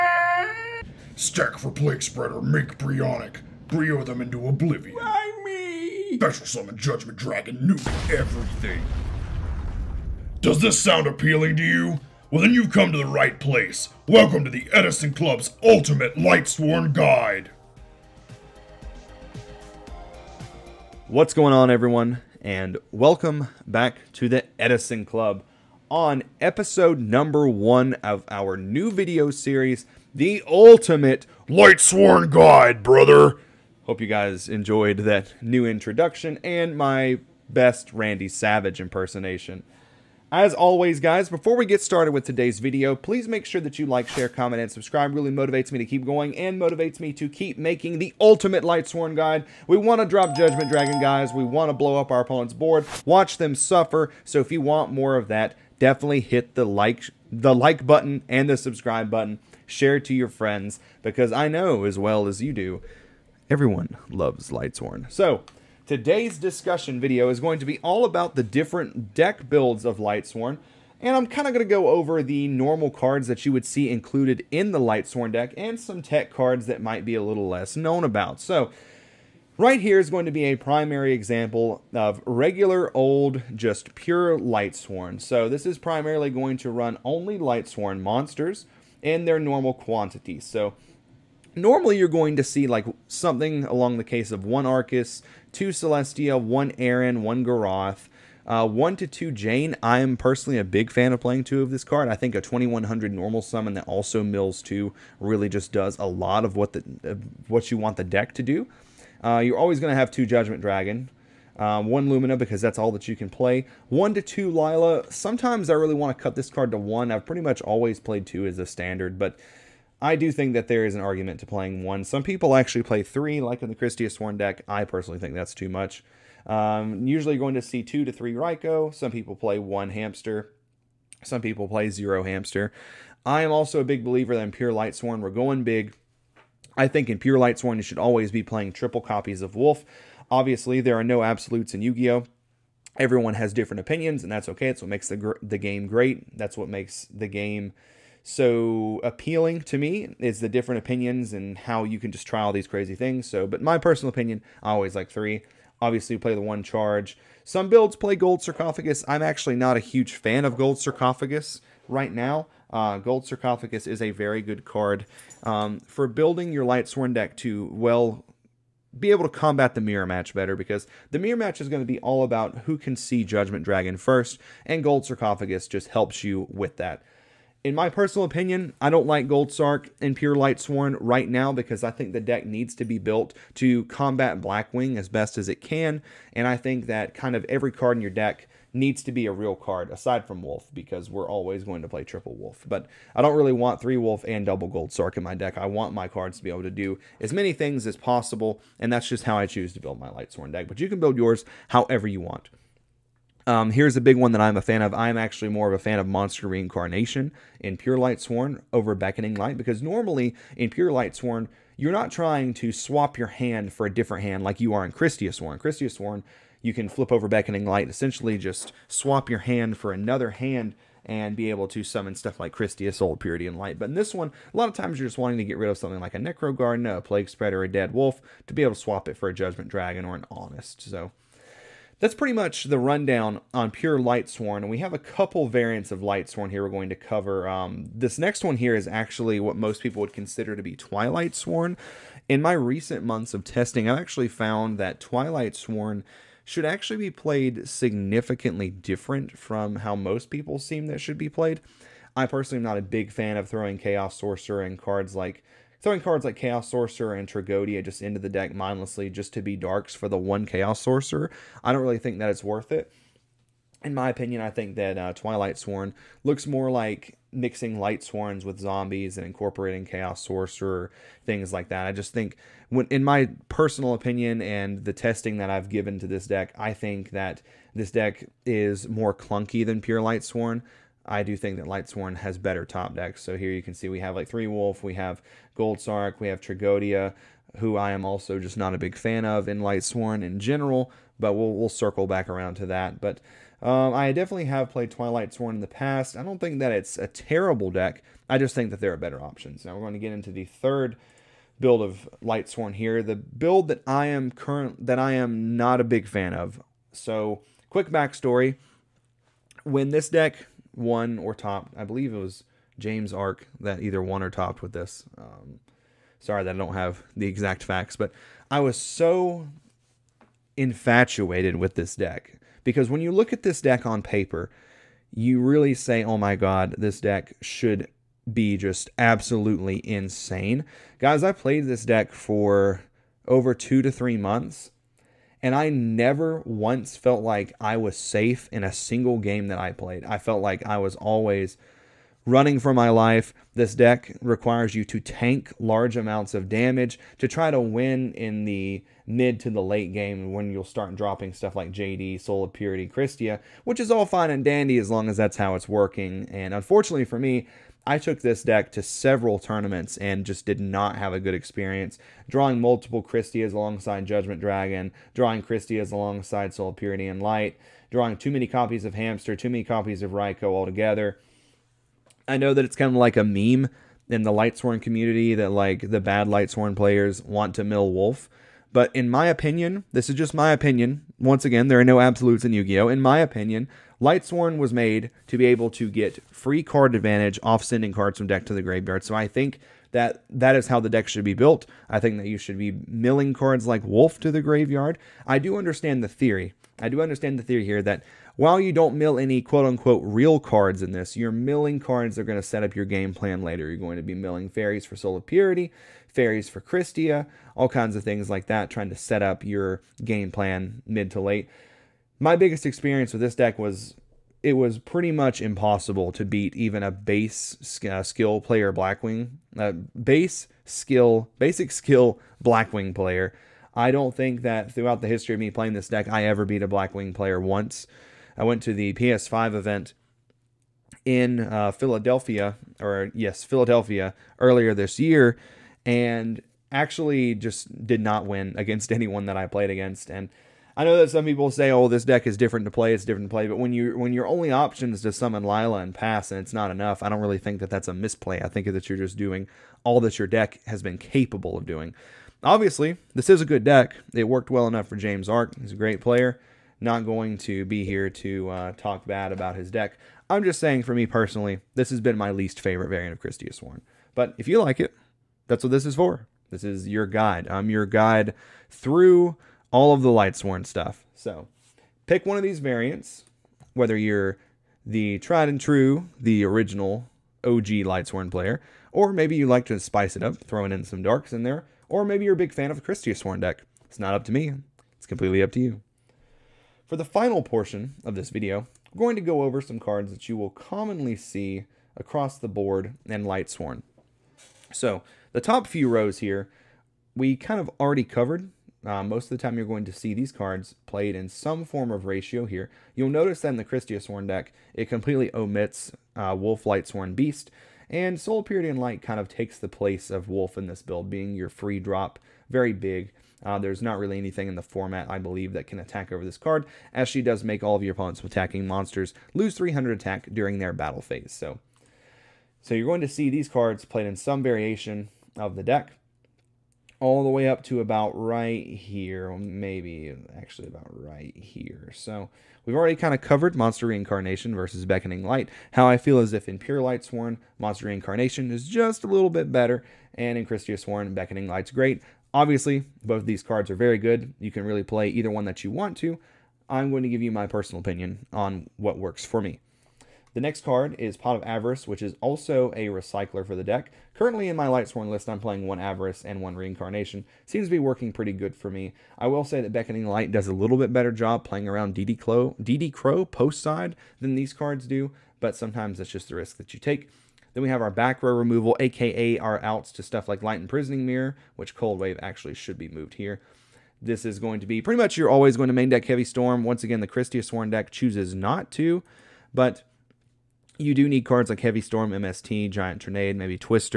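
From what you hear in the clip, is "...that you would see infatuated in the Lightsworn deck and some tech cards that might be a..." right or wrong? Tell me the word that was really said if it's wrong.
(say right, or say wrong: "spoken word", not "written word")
wrong: "included", not "infatuated".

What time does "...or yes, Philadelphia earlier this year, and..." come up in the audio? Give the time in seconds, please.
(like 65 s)
432 s.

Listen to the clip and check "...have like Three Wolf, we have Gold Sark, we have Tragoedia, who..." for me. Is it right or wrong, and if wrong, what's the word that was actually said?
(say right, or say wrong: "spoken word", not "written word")
right.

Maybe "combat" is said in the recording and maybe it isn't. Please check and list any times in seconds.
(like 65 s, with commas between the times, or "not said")
169 s, 183 s.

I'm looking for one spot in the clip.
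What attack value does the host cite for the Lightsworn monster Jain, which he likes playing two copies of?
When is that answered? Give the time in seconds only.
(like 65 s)
102 s.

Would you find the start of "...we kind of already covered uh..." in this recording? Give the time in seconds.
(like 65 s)
497 s.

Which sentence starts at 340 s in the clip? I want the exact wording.
I felt like I was always running for my life.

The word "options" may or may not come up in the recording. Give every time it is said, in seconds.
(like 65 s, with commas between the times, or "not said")
299 s, 444 s.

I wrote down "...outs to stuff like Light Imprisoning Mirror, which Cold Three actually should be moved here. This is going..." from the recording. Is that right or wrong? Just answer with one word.
wrong.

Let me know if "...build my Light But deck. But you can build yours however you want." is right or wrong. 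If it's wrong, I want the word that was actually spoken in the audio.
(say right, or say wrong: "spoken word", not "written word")
wrong: "Sworn", not "But".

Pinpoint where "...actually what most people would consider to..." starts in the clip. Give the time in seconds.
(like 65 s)
238 s.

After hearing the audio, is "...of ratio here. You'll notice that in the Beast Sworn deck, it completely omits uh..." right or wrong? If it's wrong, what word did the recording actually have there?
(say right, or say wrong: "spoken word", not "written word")
wrong: "Christia", not "Beast".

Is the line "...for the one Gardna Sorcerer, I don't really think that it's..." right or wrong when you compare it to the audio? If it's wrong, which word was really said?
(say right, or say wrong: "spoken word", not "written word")
wrong: "Chaos", not "Gardna".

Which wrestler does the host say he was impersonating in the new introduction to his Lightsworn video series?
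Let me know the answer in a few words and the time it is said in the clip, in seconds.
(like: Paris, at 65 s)
Randy Savage, at 37 s.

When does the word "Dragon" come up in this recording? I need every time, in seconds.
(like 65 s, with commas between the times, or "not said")
7 s, 50 s, 110 s, 173 s, 229 s, 364 s.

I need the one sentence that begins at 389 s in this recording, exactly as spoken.
So I think that that is how the deck should be built.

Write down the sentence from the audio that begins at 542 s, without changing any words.
Obviously, both these cards are very good.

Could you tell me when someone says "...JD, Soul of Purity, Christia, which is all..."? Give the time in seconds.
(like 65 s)
351 s.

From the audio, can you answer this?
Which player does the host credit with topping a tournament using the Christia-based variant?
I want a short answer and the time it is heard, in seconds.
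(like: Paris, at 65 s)
James Arc, at 312 s.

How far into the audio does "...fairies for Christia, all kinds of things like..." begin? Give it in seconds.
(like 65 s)
406 s.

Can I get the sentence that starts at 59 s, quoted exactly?
Share to your friends because I know as well as you do, everyone loves Lightsworn.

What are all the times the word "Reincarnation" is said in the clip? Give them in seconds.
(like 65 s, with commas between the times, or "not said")
206 s, 533 s, 537 s, 556 s.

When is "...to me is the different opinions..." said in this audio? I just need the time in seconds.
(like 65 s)
149 s.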